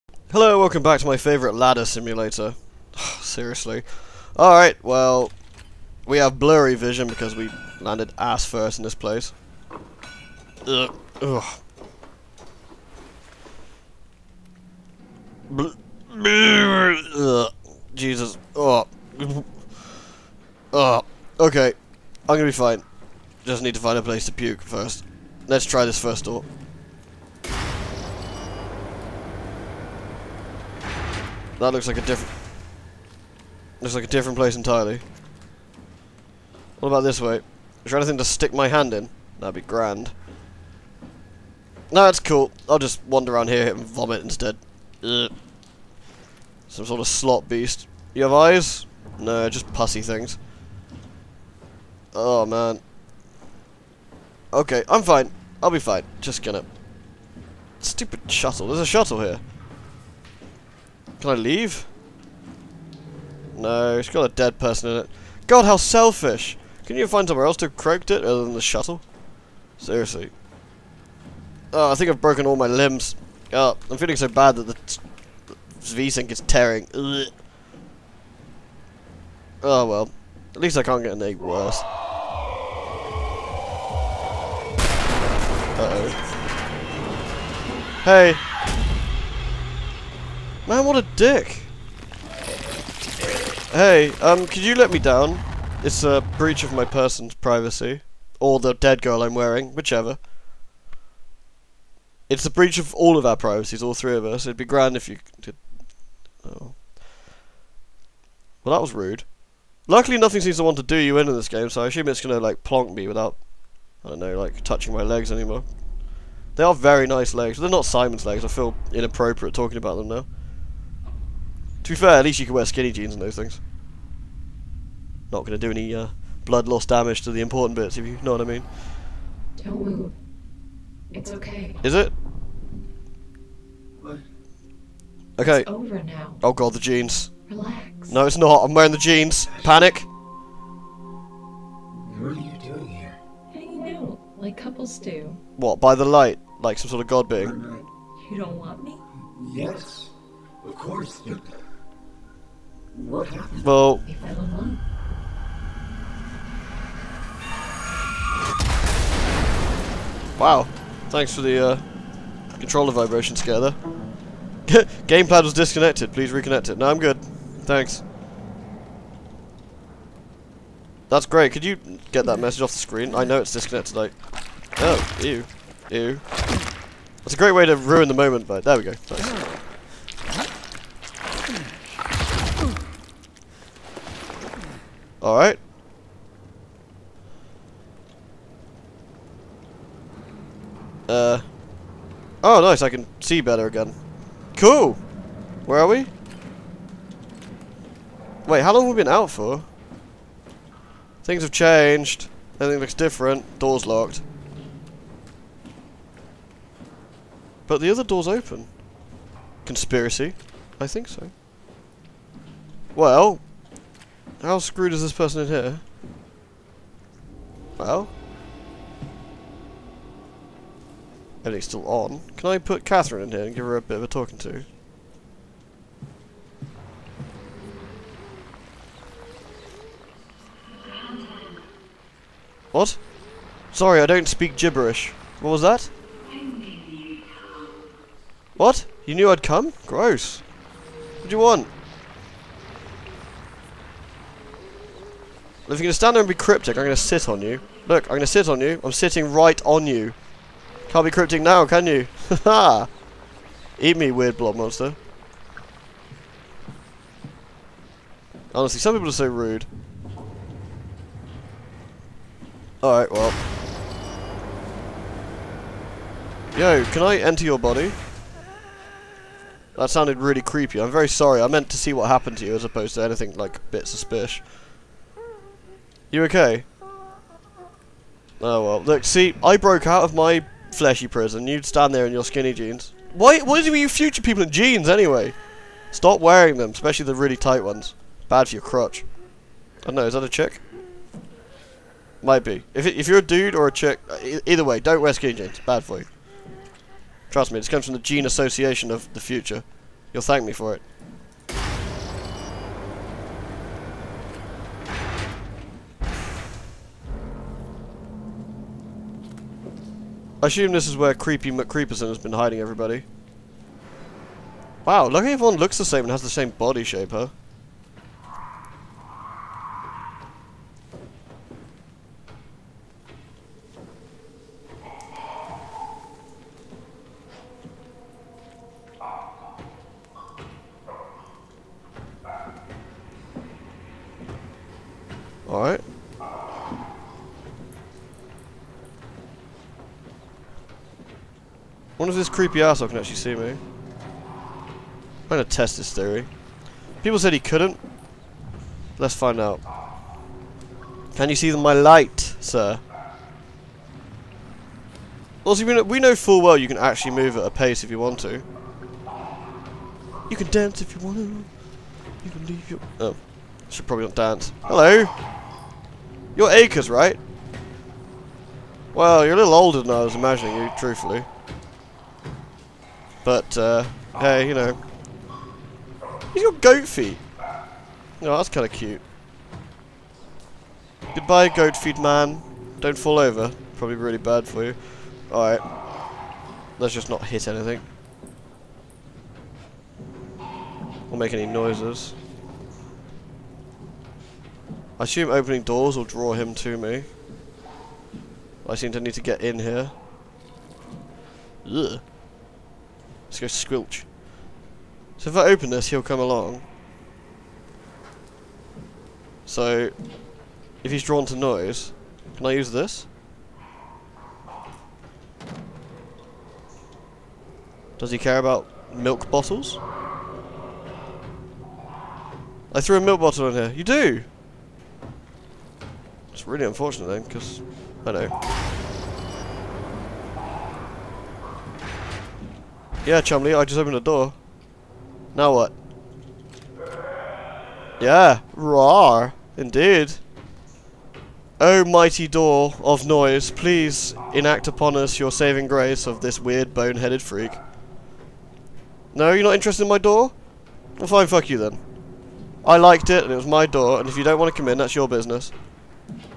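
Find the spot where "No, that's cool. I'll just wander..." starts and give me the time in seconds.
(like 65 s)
41 s.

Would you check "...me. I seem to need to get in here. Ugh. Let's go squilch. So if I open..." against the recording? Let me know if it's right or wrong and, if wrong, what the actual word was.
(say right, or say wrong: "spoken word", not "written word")
right.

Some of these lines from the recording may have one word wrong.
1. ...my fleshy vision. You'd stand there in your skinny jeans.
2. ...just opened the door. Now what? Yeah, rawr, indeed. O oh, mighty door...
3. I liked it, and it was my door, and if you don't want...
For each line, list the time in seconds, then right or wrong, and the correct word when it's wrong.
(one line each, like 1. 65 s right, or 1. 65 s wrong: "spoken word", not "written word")
1. 280 s wrong: "prison", not "vision"
2. 433 s right
3. 452 s right.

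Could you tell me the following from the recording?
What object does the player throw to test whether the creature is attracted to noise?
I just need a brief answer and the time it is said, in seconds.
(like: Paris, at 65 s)
milk bottle, at 423 s.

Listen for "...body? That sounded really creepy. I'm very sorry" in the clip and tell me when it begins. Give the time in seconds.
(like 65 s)
267 s.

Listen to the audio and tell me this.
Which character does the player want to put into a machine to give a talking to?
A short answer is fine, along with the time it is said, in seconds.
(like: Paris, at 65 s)
Catherine, at 222 s.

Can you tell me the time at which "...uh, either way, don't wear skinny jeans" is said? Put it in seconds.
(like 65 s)
294 s.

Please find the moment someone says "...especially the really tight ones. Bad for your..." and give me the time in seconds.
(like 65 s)
286 s.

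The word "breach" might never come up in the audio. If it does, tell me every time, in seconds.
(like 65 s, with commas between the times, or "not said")
96 s, 102 s.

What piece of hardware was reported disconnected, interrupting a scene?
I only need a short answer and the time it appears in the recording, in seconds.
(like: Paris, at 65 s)
Gamepad, at 165 s.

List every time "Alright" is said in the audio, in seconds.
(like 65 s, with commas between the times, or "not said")
4 s, 185 s, 262 s, 385 s.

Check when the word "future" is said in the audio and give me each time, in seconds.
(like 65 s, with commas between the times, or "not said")
283 s, 299 s.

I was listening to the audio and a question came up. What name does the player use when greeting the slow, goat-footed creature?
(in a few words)
Acres.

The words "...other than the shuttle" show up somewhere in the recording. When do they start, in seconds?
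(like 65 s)
68 s.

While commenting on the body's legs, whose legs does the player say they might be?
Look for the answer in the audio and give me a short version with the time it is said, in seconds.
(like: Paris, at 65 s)
Simon's, at 117 s.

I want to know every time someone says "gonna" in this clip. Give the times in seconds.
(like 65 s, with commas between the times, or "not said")
22 s, 56 s, 345 s.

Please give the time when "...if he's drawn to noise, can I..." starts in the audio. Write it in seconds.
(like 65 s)
410 s.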